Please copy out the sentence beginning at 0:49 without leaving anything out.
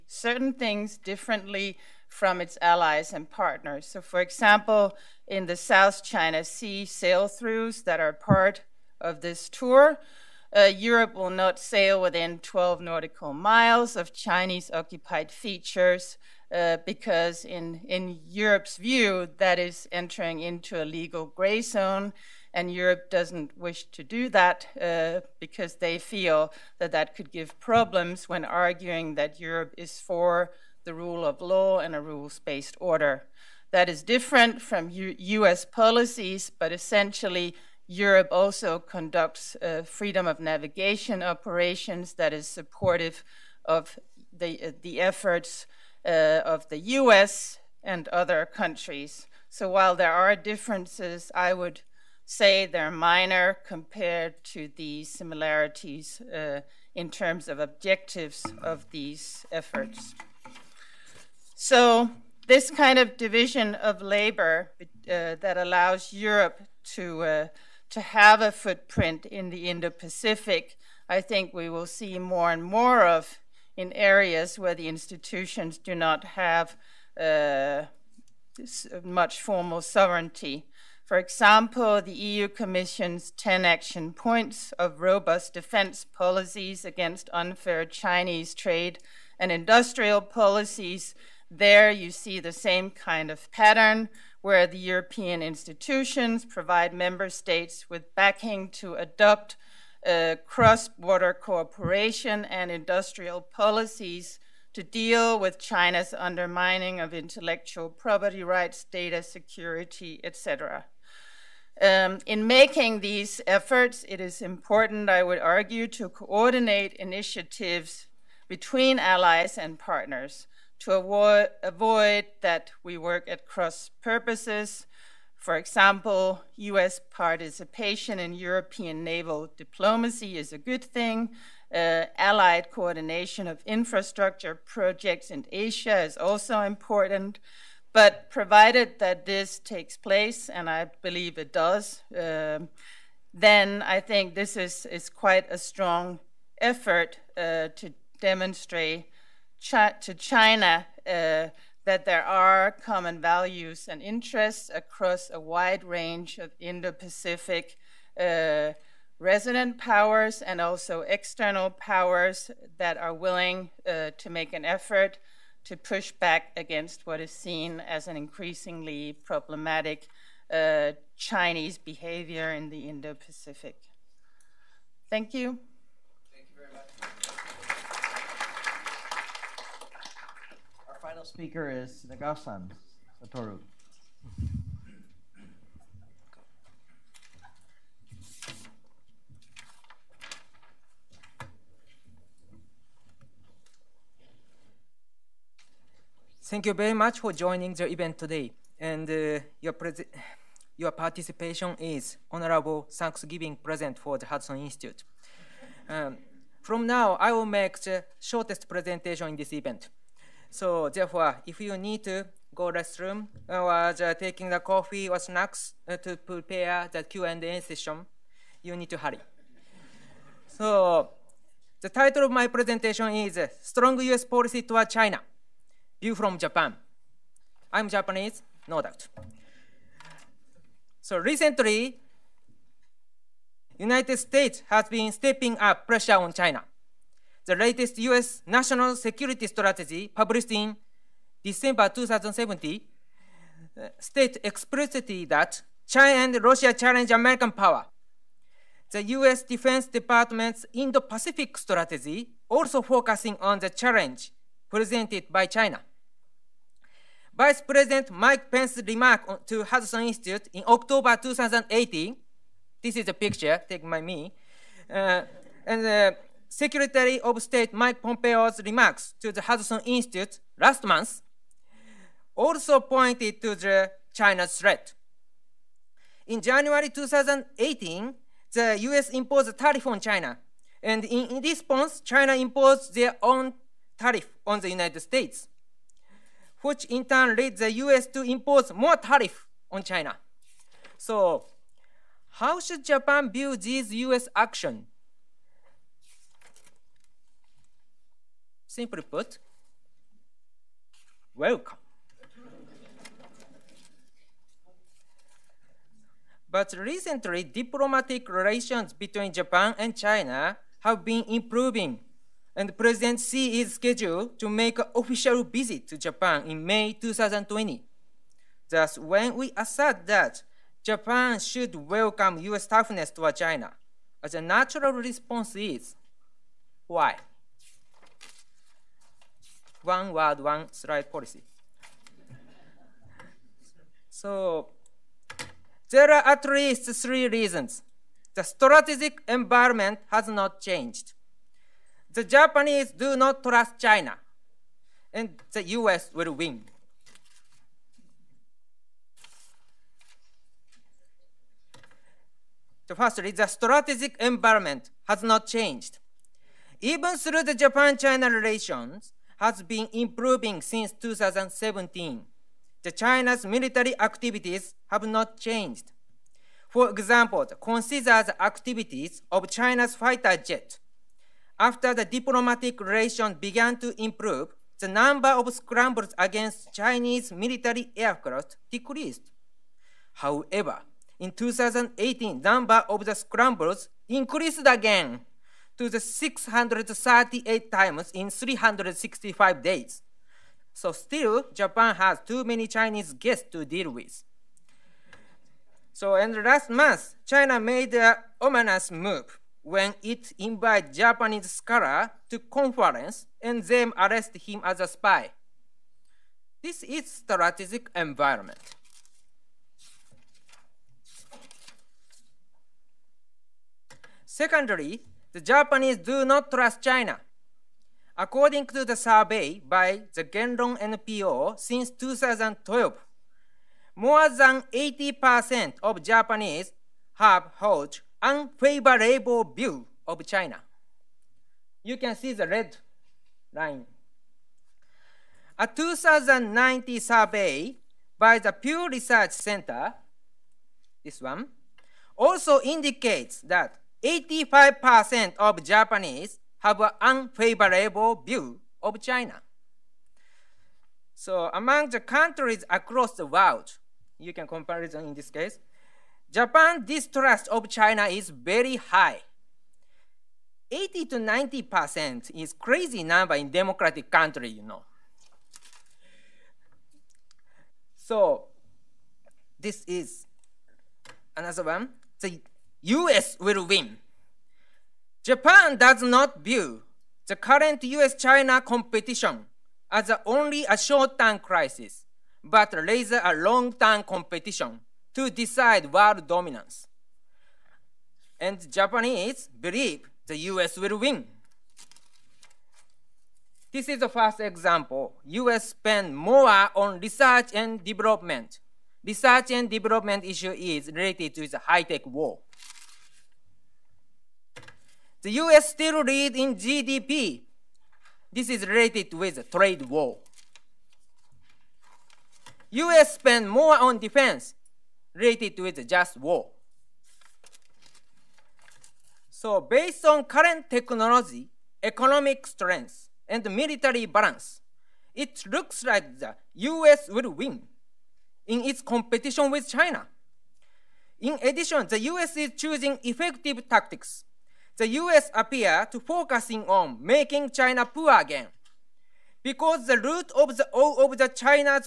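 So while there are differences, I would say they're minor compared to the similarities uh, in terms of objectives of these efforts.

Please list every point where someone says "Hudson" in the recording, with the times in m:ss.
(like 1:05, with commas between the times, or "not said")
3:24, 4:19, 4:29.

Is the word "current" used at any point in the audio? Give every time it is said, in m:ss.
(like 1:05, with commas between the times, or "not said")
7:57, 8:40.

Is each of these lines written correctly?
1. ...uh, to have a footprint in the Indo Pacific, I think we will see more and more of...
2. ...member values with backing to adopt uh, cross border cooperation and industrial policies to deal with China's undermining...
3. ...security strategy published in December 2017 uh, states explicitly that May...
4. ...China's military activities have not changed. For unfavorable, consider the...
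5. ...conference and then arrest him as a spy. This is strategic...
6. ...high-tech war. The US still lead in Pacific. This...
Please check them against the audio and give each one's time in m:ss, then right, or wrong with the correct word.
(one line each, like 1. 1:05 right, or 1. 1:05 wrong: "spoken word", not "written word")
1. 1:07 right
2. 1:36 wrong: "states", not "values"
3. 3:58 wrong: "China", not "May"
4. 6:02 wrong: "example", not "unfavorable"
5. 6:42 right
6. 8:21 wrong: "GDP", not "Pacific".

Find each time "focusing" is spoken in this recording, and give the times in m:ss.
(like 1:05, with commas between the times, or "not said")
4:12, 8:55.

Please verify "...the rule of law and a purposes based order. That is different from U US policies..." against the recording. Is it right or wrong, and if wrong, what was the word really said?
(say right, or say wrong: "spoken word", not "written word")
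wrong: "rules", not "purposes".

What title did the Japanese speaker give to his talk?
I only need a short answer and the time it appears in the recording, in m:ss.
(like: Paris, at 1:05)
Strong U.S. Policy Toward China, at 3:43.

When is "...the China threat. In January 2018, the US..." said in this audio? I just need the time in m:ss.
4:33.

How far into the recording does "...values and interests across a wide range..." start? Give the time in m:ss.
2:33.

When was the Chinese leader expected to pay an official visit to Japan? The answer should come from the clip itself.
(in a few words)
May 2020.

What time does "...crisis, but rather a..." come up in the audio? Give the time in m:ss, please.
8:01.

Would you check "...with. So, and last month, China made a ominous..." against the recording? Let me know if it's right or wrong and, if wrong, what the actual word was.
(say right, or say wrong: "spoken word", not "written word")
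right.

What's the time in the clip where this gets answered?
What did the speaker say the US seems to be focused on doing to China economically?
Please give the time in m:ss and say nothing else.
8:57.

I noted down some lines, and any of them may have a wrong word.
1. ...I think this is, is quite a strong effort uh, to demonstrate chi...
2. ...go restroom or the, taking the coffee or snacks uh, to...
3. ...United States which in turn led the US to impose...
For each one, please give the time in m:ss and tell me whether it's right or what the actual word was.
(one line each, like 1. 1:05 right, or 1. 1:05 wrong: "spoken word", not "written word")
1. 2:23 right
2. 3:32 right
3. 4:44 right.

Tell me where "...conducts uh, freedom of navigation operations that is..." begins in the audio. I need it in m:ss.
0:38.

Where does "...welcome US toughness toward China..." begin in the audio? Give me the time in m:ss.
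5:21.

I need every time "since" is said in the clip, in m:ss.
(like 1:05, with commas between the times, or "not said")
6:00, 7:01.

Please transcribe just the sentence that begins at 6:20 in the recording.
However, in 2018, number of the scrambles increased again to the 638 times in 365 days.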